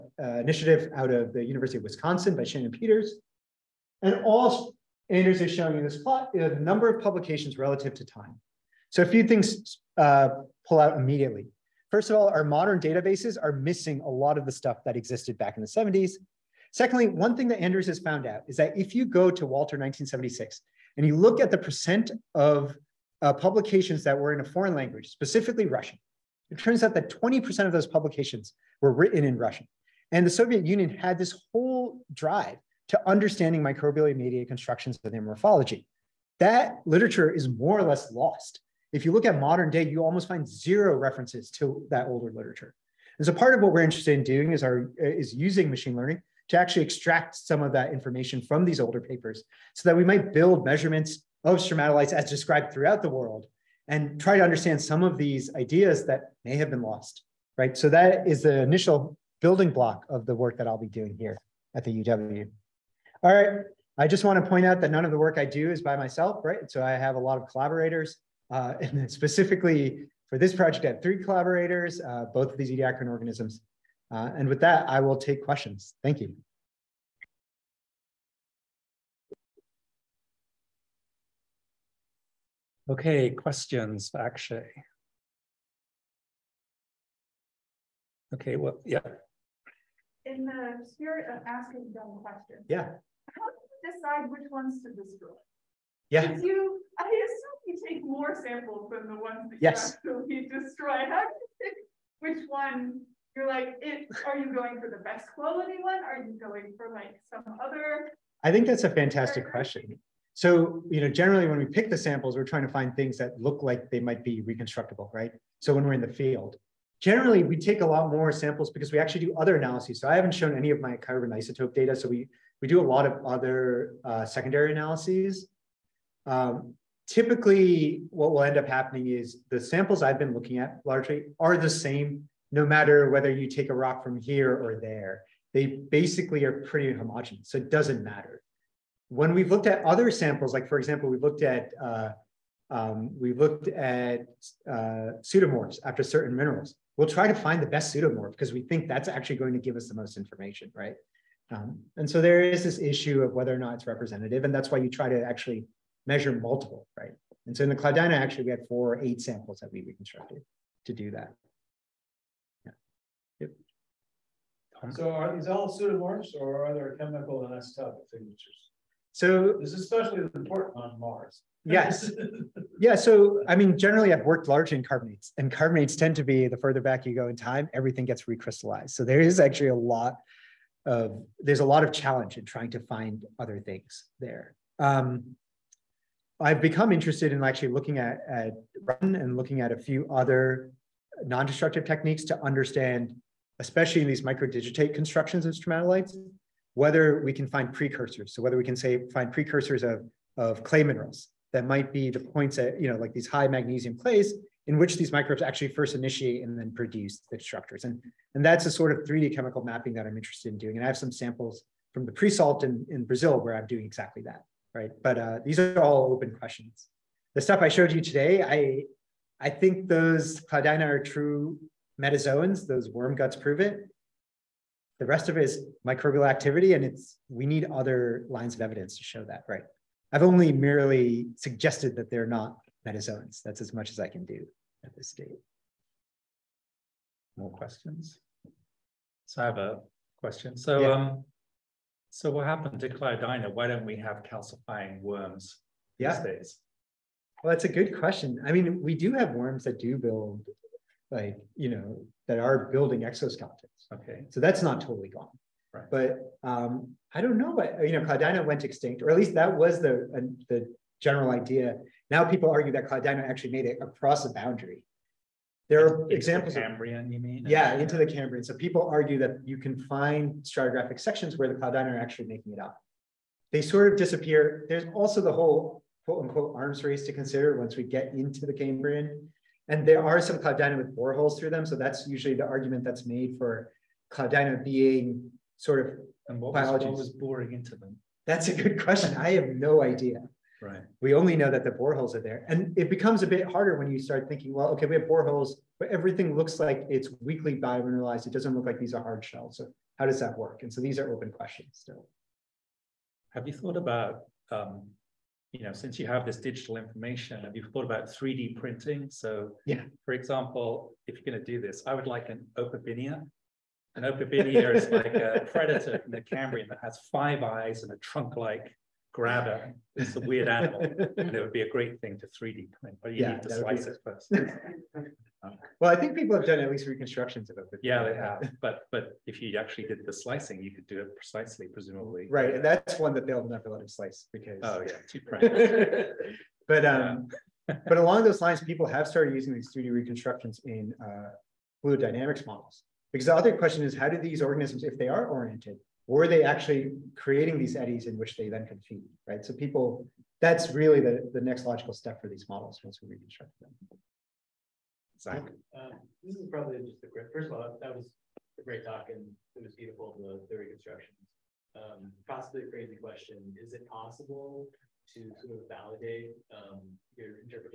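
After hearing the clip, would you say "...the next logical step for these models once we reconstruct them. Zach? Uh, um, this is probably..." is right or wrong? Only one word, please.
right.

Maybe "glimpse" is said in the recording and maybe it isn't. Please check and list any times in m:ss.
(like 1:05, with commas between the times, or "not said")
not said.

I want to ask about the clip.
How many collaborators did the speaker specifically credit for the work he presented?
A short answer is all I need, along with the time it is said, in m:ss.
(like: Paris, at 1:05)
3, at 1:11.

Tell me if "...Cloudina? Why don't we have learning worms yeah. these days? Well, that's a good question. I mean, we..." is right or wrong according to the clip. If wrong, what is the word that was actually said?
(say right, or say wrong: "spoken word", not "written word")
wrong: "calcifying", not "learning".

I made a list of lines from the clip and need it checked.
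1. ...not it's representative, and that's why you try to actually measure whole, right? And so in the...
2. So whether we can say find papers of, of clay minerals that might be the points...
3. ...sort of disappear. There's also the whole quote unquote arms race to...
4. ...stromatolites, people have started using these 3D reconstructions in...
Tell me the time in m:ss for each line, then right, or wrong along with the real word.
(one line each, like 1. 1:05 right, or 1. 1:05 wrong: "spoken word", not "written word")
1. 2:33 wrong: "multiple", not "whole"
2. 3:18 wrong: "precursors", not "papers"
3. 4:33 right
4. 5:38 wrong: "lines", not "stromatolites".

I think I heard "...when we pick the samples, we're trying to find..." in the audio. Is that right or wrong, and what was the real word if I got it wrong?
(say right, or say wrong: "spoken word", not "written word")
right.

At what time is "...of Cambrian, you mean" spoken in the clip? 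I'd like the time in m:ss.
4:26.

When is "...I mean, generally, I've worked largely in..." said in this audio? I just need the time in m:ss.
2:53.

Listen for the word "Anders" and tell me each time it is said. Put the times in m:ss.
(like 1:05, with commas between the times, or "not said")
0:05, 0:17.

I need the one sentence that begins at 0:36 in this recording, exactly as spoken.
That literature is more or less lost.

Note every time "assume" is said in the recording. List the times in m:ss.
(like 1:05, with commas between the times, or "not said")
1:37.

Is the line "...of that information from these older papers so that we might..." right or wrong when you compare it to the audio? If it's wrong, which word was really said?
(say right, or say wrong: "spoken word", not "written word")
right.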